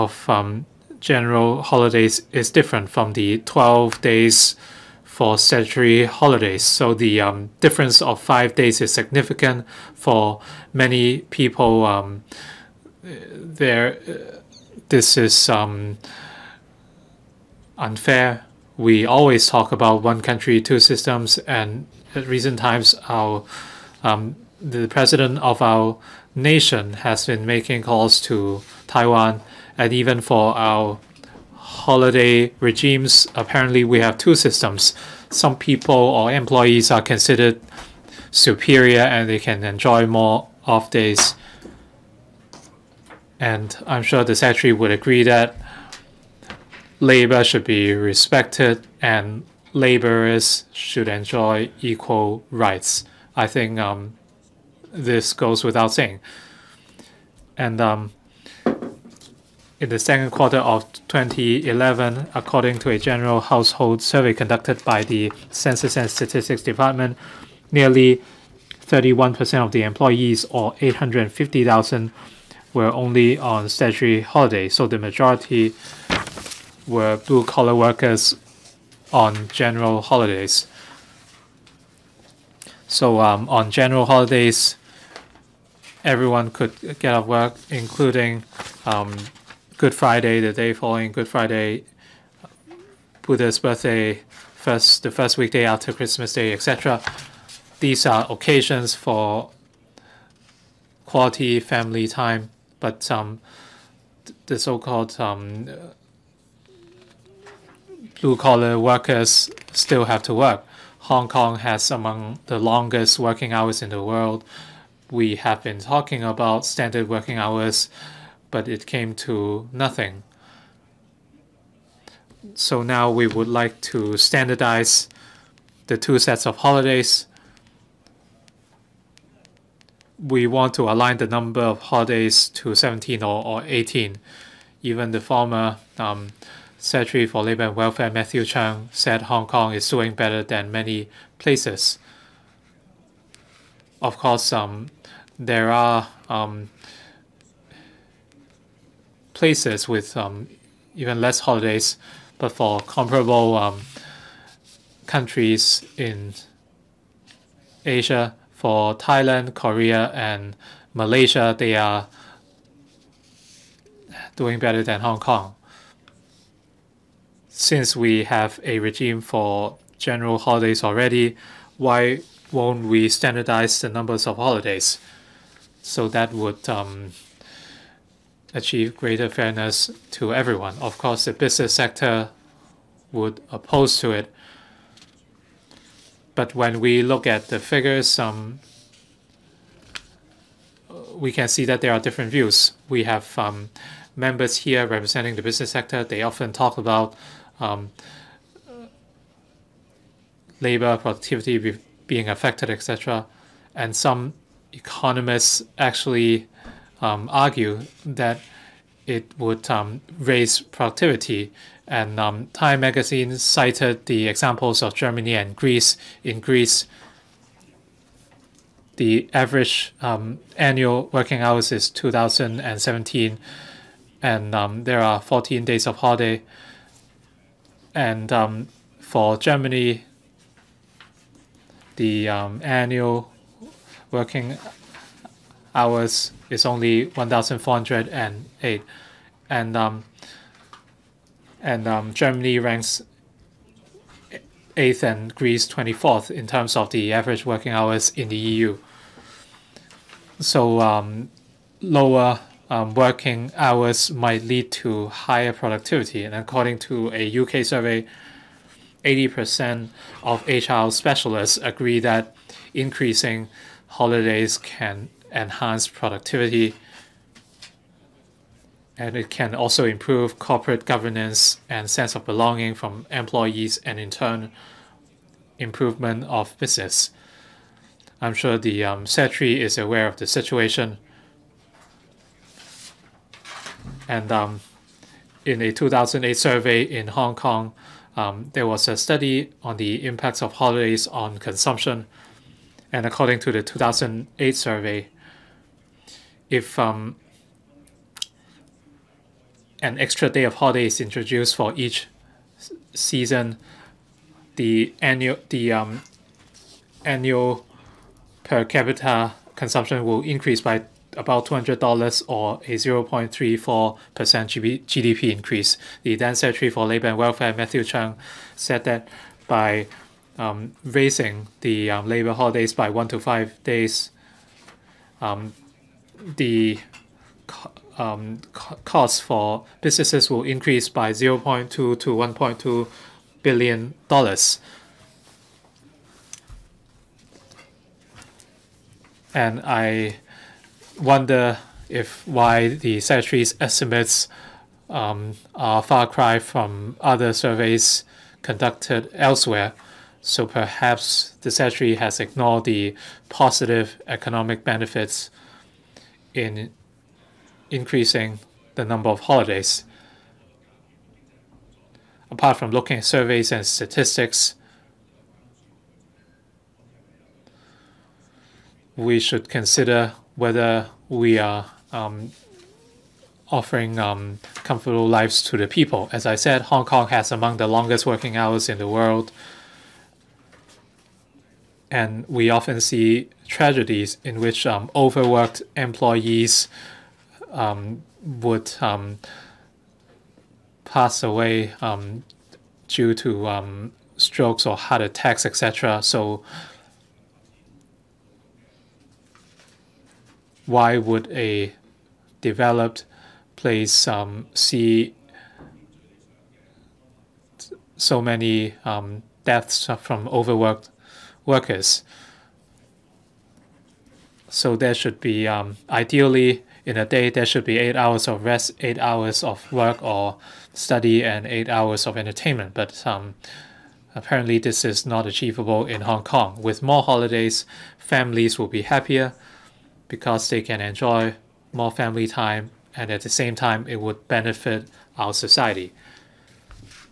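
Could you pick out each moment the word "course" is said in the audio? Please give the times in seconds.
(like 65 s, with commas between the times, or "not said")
144 s, 180 s.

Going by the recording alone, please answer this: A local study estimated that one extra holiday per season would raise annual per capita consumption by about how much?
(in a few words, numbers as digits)
$200.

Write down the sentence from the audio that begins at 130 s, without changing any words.
We want to align the number of holidays to 17 or, or 18.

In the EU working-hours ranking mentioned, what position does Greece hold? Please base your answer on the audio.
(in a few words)
24th.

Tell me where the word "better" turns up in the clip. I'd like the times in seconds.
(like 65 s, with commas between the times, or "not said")
140 s, 164 s.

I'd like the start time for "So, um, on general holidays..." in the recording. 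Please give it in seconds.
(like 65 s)
82 s.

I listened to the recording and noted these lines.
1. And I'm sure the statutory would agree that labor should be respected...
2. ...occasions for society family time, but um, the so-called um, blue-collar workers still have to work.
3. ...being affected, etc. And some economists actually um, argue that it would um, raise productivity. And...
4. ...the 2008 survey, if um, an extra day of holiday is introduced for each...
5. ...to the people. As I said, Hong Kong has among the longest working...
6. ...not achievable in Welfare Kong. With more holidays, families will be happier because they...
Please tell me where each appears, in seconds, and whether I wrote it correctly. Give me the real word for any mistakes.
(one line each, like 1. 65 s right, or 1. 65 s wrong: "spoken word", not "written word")
1. 43 s wrong: "secretary", not "statutory"
2. 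98 s wrong: "quality", not "society"
3. 202 s right
4. 293 s right
5. 375 s right
6. 425 s wrong: "Hong", not "Welfare".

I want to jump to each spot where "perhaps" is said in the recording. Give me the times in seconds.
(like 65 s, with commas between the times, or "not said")
350 s.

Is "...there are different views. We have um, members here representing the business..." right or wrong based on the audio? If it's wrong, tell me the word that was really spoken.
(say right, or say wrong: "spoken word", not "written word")
right.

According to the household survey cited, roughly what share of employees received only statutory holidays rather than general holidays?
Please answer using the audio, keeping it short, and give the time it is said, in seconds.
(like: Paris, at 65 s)
31%, at 68 s.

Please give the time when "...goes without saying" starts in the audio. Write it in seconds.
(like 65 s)
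55 s.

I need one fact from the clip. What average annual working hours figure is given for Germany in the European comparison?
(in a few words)
1,408.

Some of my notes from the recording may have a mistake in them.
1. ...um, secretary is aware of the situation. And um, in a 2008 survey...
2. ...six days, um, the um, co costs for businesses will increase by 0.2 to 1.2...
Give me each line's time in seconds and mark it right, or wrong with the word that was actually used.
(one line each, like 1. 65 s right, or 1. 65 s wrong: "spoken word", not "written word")
1. 278 s right
2. 323 s wrong: "five", not "six".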